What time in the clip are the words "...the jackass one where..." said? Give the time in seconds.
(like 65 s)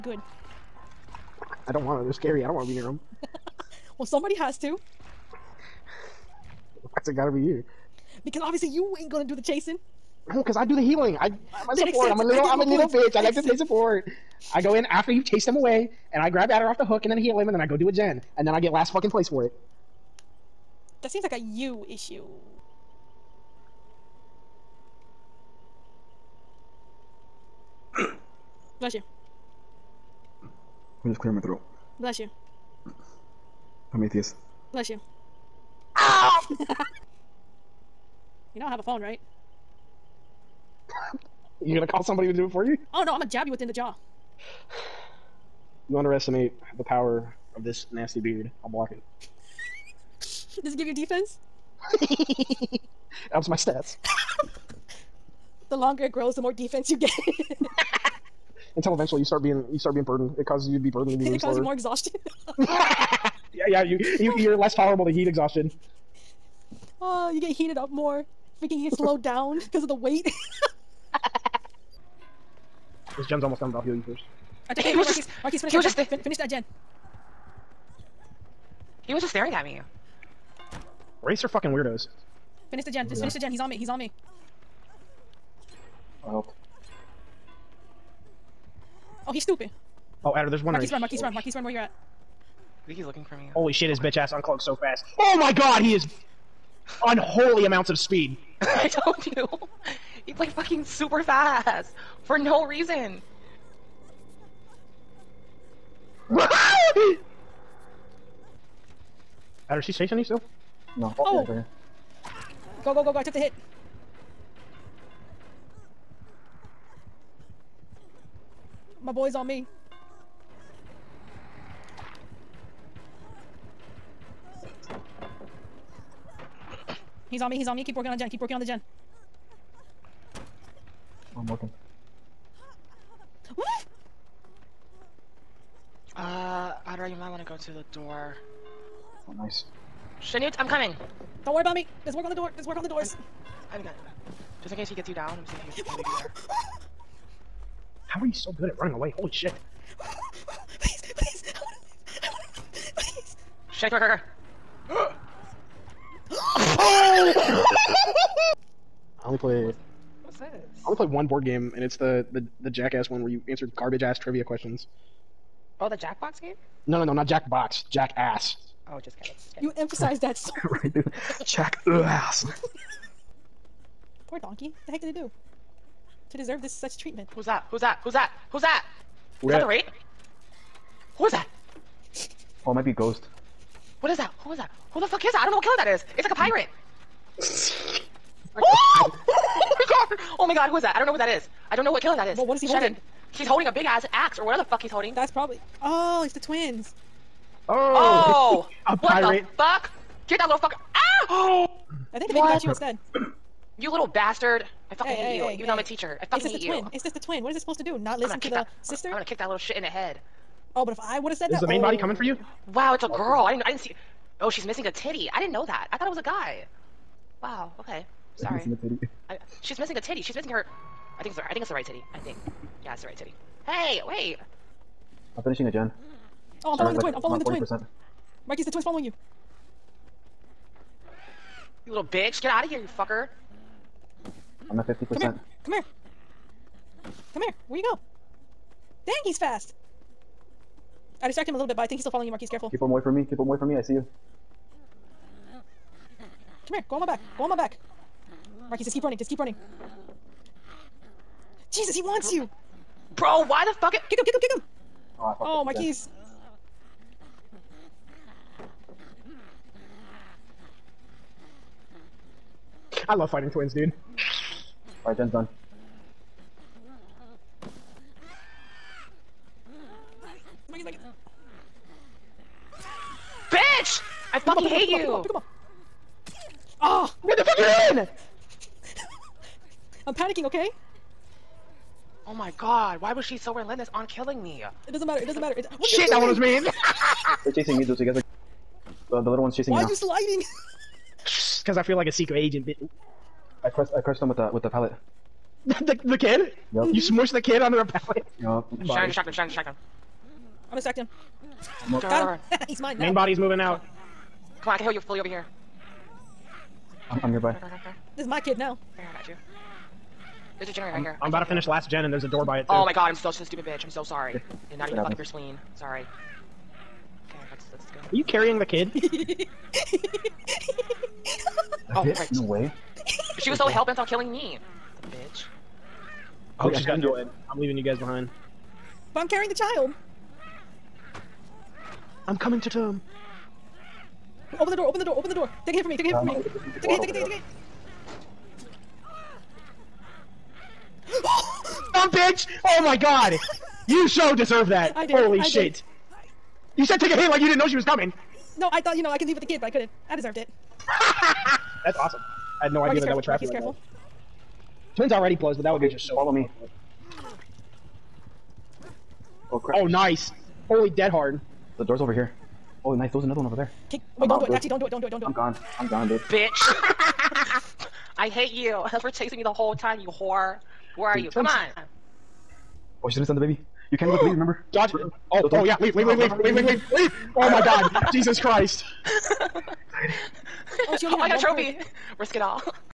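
162 s.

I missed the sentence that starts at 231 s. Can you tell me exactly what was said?
You little bitch, get out of here, you fucker.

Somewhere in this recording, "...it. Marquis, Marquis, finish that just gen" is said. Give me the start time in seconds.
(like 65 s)
74 s.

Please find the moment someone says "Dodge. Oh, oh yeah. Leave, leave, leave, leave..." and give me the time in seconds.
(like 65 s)
374 s.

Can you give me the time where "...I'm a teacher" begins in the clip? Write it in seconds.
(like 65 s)
205 s.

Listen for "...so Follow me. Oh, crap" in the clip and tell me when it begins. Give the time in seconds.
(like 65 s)
356 s.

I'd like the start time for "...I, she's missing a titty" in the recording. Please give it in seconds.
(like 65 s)
219 s.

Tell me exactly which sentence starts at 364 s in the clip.
Wait, I'm don't out, do it.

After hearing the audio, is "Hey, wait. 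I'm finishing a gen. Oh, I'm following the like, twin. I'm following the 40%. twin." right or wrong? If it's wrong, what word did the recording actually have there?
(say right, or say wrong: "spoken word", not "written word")
right.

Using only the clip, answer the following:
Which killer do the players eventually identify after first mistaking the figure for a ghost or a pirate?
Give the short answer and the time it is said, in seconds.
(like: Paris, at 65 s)
the twins, at 195 s.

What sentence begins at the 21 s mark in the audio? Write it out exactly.
That seems like a you issue.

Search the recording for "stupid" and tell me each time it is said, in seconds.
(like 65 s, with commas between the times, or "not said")
89 s, 313 s.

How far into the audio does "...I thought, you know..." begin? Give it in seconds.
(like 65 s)
348 s.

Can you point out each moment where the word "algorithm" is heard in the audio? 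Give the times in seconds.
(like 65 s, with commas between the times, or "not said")
not said.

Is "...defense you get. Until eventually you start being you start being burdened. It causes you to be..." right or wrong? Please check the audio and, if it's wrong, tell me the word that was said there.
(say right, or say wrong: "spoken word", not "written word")
right.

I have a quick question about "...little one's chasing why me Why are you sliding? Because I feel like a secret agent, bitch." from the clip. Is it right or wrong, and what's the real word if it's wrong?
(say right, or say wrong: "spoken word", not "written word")
right.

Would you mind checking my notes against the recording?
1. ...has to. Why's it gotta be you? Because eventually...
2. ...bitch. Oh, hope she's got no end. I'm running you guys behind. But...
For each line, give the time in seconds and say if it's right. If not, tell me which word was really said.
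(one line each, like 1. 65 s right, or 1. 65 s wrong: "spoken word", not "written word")
1. 4 s wrong: "obviously", not "eventually"
2. 325 s wrong: "leaving", not "running".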